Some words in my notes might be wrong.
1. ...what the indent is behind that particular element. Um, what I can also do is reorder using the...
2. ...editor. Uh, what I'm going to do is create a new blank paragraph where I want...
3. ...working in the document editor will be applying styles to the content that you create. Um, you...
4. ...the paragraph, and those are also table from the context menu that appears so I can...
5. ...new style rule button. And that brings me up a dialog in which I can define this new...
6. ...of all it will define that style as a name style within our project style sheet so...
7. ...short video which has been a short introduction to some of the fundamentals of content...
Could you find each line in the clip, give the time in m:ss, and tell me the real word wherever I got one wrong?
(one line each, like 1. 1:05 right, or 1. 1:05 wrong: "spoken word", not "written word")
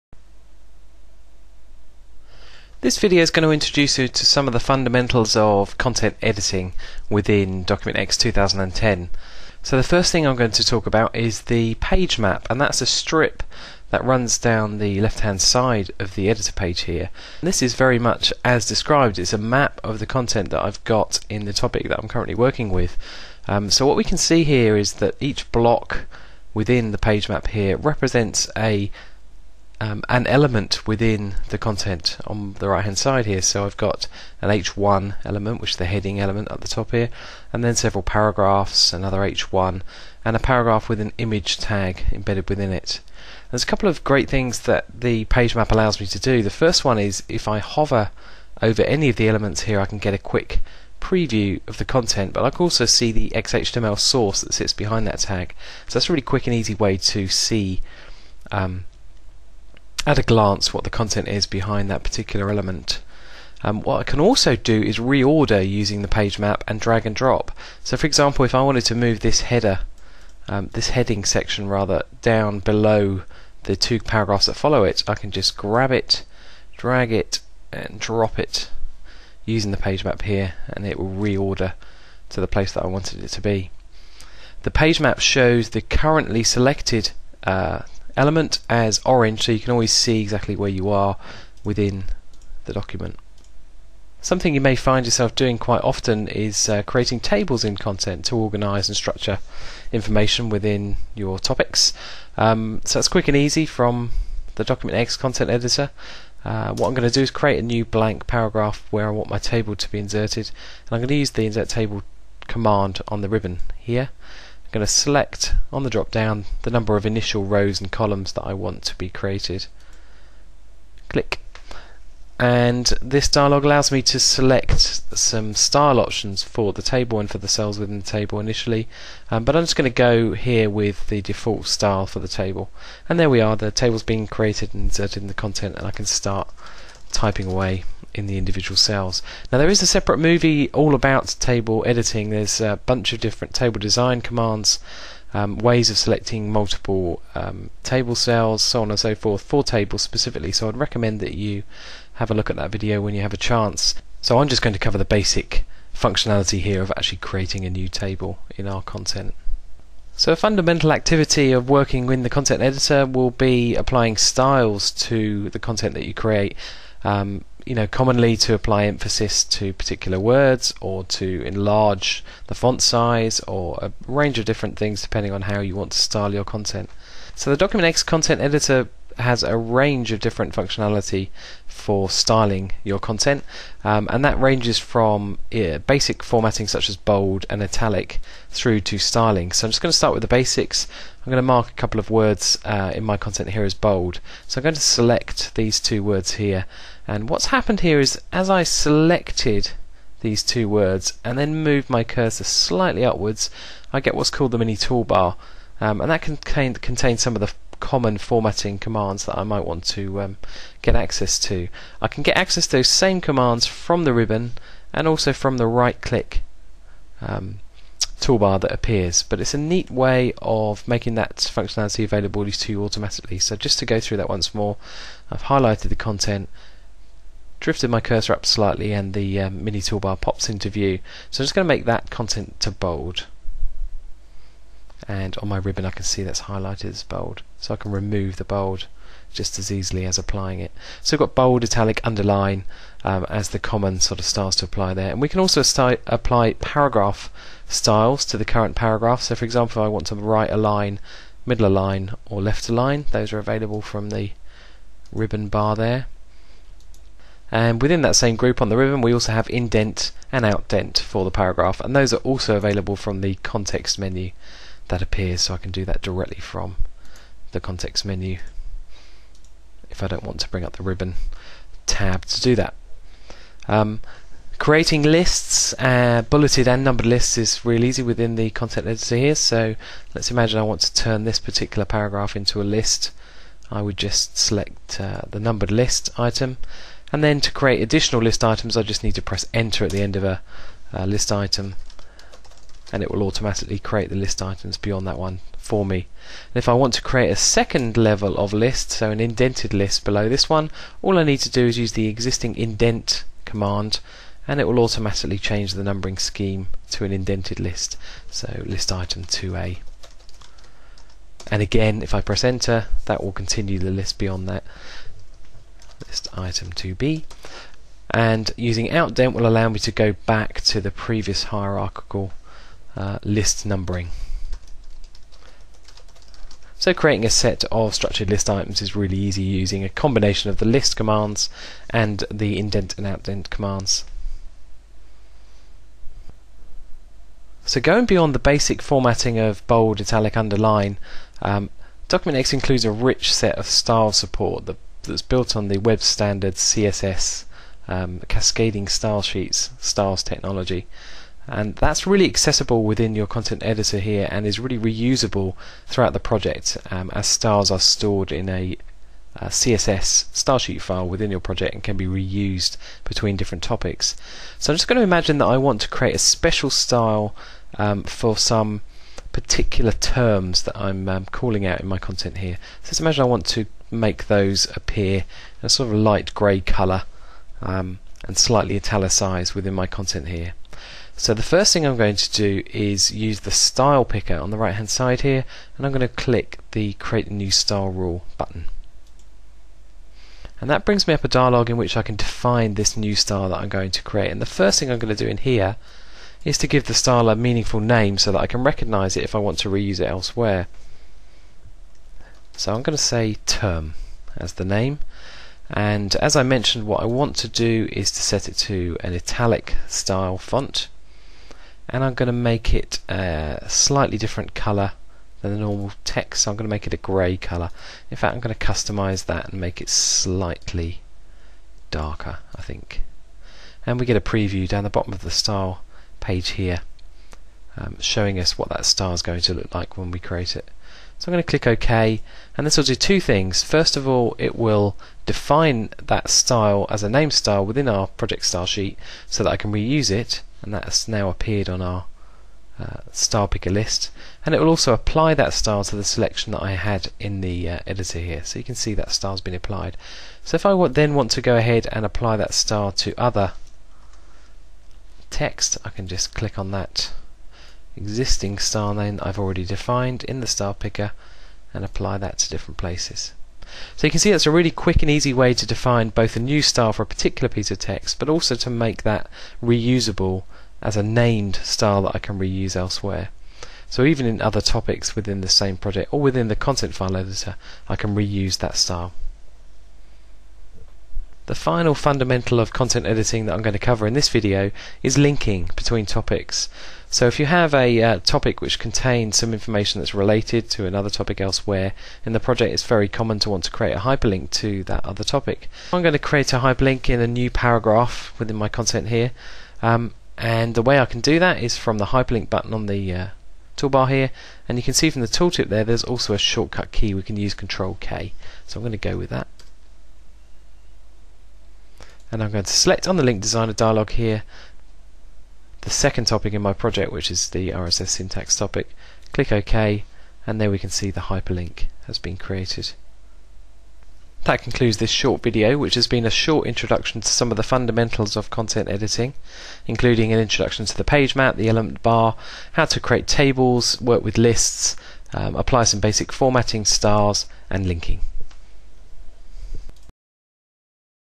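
1. 1:00 wrong: "content", not "indent"
2. 1:45 right
3. 2:41 wrong: "content", not "document"
4. 4:21 wrong: "available", not "table"
5. 6:27 right
6. 7:13 right
7. 8:45 right.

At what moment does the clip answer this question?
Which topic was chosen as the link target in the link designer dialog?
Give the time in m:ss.
8:37.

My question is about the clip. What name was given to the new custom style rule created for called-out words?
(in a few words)
term.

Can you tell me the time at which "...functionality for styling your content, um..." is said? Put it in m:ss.
3:00.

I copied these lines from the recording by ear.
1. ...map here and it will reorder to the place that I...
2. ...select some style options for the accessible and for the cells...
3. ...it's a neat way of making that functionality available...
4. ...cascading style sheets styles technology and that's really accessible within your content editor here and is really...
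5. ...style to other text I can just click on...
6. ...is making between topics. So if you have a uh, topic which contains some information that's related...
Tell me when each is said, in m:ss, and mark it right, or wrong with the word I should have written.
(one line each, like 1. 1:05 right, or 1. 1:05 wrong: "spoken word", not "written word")
1. 1:20 right
2. 2:04 wrong: "table", not "accessible"
3. 3:39 right
4. 5:48 right
5. 7:32 right
6. 8:05 wrong: "linking", not "making".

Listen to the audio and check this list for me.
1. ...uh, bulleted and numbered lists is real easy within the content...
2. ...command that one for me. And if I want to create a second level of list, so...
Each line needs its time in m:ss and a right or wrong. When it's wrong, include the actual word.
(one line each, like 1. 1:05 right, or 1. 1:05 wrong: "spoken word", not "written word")
1. 4:35 right
2. 4:54 wrong: "beyond", not "command".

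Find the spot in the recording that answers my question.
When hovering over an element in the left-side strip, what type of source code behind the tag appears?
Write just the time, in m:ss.
0:53.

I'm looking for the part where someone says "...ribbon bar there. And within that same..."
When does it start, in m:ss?
4:15.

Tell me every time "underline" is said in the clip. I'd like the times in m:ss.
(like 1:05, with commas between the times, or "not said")
4:02, 5:40.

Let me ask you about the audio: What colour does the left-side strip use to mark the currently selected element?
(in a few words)
orange.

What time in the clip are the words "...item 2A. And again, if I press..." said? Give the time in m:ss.
5:08.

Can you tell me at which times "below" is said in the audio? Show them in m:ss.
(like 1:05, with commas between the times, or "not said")
1:12, 5:00.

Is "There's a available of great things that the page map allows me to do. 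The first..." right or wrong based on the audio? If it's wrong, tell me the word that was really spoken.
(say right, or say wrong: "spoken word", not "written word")
wrong: "couple", not "available".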